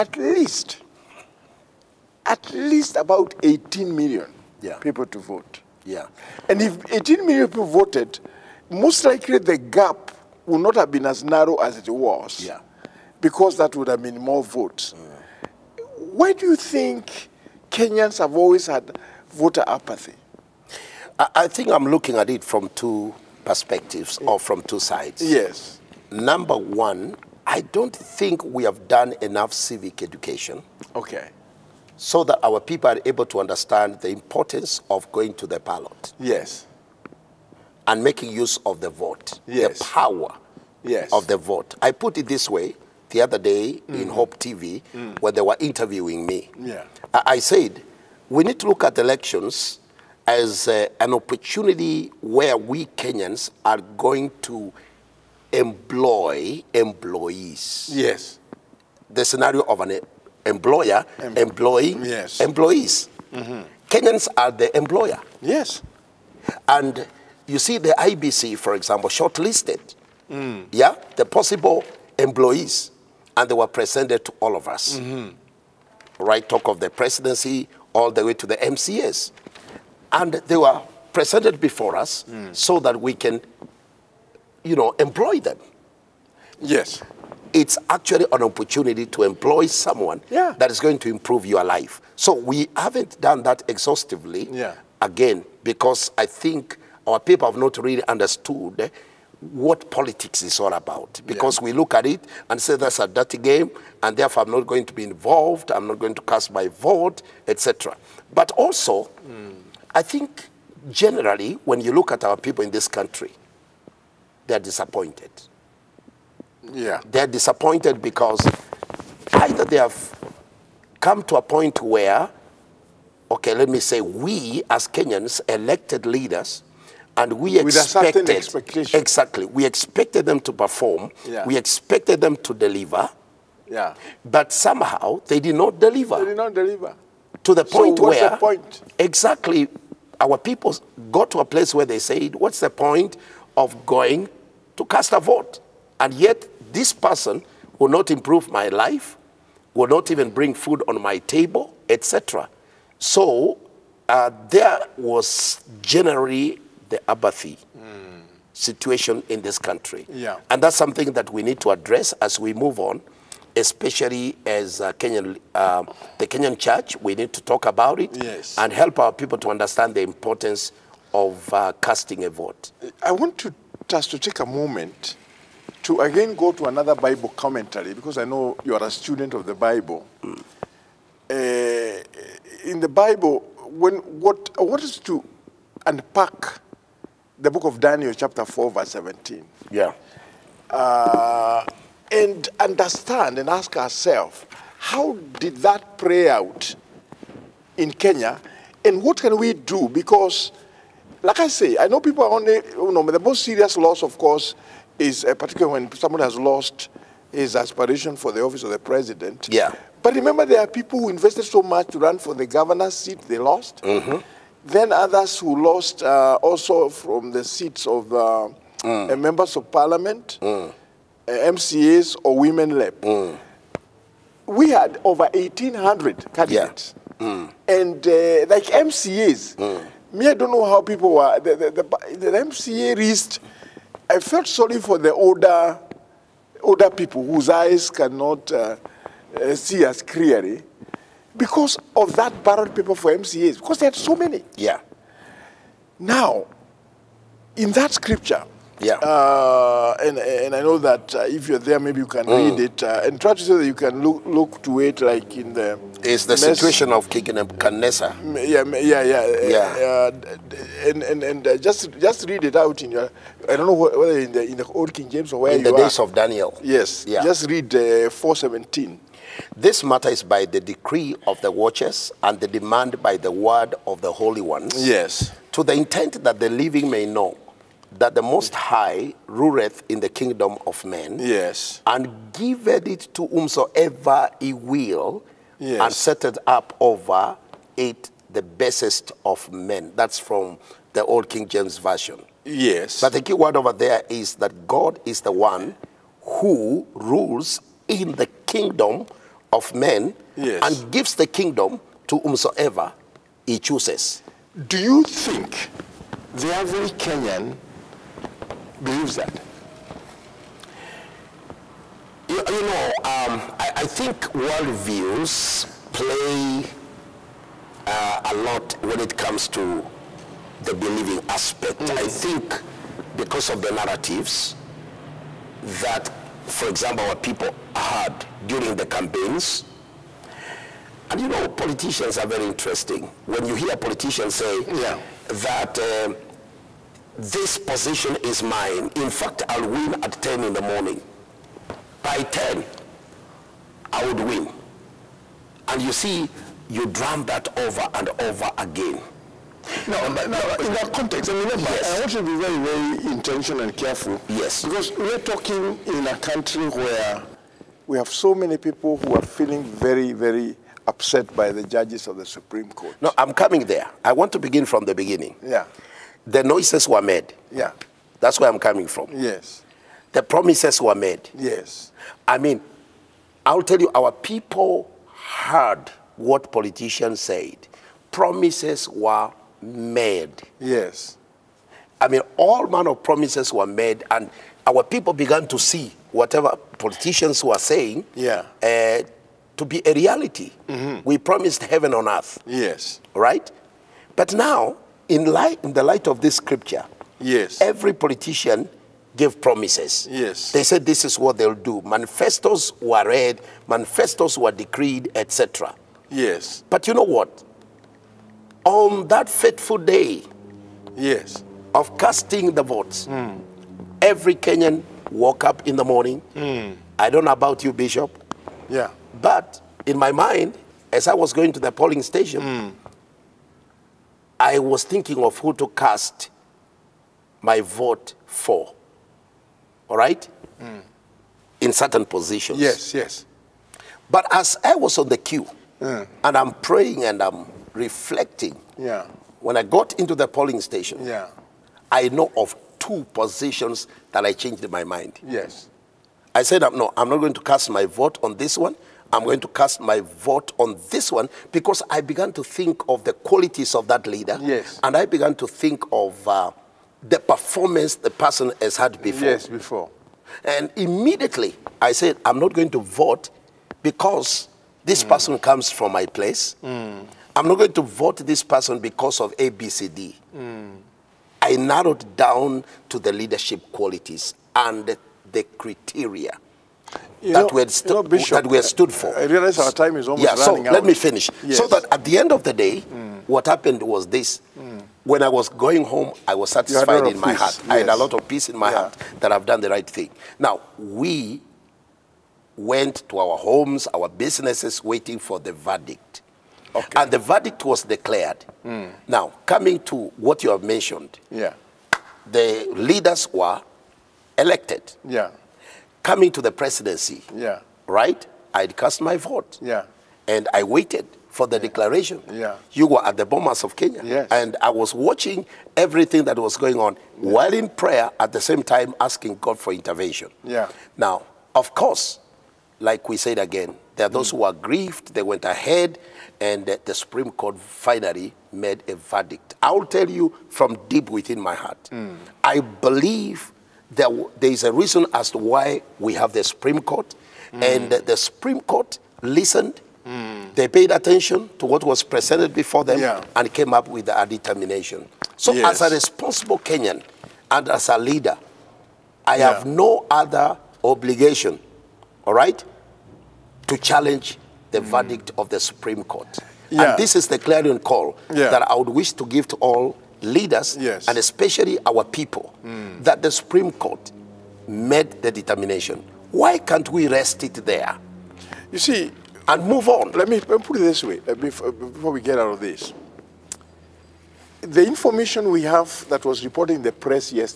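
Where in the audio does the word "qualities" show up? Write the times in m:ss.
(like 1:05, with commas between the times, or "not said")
7:33, 7:53.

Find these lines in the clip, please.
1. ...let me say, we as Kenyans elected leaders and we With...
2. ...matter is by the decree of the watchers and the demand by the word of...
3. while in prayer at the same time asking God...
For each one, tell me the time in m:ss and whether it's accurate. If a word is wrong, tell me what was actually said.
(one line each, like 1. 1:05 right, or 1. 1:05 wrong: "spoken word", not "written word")
1. 2:03 right
2. 4:29 right
3. 8:37 right.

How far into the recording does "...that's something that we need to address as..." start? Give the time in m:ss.
2:40.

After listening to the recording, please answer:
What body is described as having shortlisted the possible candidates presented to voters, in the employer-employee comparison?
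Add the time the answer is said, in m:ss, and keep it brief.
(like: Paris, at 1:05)
IEBC, at 1:07.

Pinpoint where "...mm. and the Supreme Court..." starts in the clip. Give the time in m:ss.
8:57.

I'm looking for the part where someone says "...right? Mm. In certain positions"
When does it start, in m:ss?
7:09.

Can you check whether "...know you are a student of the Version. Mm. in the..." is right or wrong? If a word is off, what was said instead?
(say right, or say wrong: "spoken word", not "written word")
wrong: "Bible", not "Version".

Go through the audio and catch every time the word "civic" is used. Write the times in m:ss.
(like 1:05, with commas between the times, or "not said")
0:29.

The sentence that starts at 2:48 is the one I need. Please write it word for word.
and help our people to understand the importance of uh, casting a vote.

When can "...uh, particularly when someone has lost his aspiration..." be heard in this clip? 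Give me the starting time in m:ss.
3:25.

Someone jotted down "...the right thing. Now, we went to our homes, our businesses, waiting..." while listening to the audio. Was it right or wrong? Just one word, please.
right.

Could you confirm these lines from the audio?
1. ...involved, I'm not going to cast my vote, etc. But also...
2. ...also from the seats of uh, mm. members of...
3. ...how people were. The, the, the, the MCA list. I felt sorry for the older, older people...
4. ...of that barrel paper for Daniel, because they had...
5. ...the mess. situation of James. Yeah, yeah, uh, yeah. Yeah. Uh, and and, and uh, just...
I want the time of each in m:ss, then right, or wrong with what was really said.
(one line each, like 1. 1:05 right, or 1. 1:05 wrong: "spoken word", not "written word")
1. 1:45 right
2. 3:36 right
3. 3:50 right
4. 4:01 wrong: "MCAs", not "Daniel"
5. 4:16 wrong: "Nebuchadnezzar", not "James".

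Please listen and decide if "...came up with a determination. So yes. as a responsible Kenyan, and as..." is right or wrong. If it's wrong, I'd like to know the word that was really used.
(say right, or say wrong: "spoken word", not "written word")
right.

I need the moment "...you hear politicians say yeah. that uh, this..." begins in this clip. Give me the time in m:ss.
5:33.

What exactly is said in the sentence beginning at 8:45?
they went ahead, and the Supreme Court finally made a verdict.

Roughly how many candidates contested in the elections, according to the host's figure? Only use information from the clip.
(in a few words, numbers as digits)
over 1,800.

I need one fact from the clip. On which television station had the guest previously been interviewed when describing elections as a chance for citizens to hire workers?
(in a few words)
Hope TV.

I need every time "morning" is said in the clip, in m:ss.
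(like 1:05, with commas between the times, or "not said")
5:40, 6:55.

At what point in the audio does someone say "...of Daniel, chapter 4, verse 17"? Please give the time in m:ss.
3:07.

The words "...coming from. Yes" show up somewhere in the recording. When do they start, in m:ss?
6:08.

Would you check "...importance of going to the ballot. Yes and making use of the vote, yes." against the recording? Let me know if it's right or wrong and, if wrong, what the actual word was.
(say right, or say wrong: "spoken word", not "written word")
right.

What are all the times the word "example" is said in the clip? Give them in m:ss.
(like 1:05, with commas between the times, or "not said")
1:08, 5:26.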